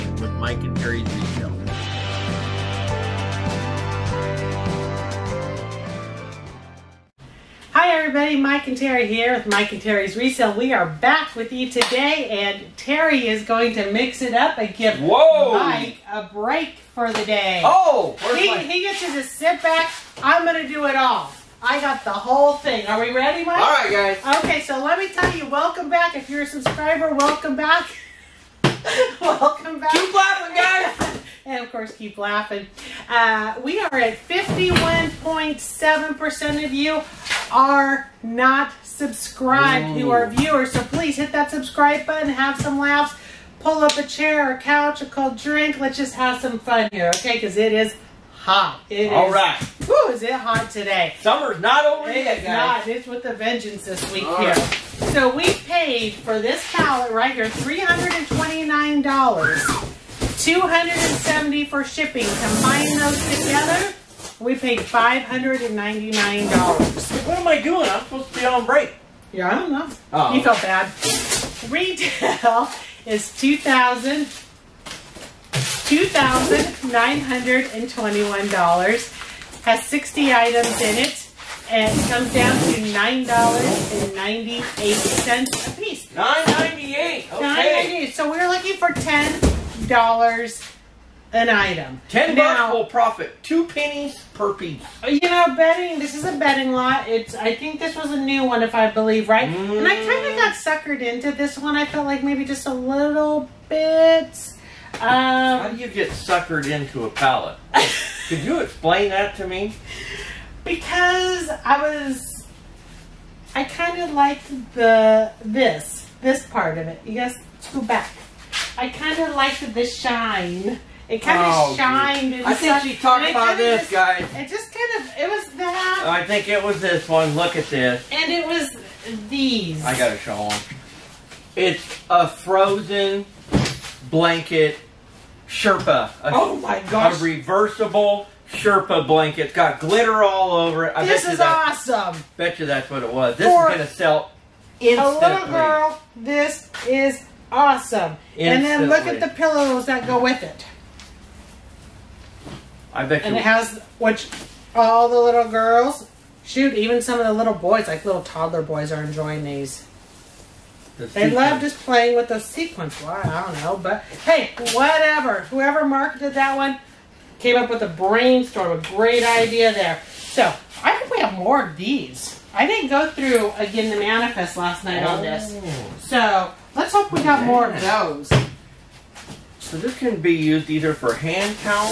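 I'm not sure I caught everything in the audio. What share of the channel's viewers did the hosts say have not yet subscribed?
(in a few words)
51.7%.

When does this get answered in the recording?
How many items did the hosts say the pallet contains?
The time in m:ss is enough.
1:19.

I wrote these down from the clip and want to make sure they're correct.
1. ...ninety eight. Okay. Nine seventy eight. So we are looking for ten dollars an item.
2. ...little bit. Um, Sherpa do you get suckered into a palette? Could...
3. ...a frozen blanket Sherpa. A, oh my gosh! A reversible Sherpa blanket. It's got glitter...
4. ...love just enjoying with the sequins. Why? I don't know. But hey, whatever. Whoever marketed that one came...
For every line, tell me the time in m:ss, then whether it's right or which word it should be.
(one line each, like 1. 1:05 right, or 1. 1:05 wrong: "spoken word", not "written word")
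1. 1:26 wrong: "ninety", not "seventy"
2. 1:42 wrong: "How", not "Sherpa"
3. 2:12 right
4. 2:41 wrong: "playing", not "enjoying".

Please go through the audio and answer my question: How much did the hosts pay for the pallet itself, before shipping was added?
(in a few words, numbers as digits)
$329.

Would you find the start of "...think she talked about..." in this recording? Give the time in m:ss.
2:02.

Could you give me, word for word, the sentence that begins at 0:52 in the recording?
It's with a vengeance this week All here.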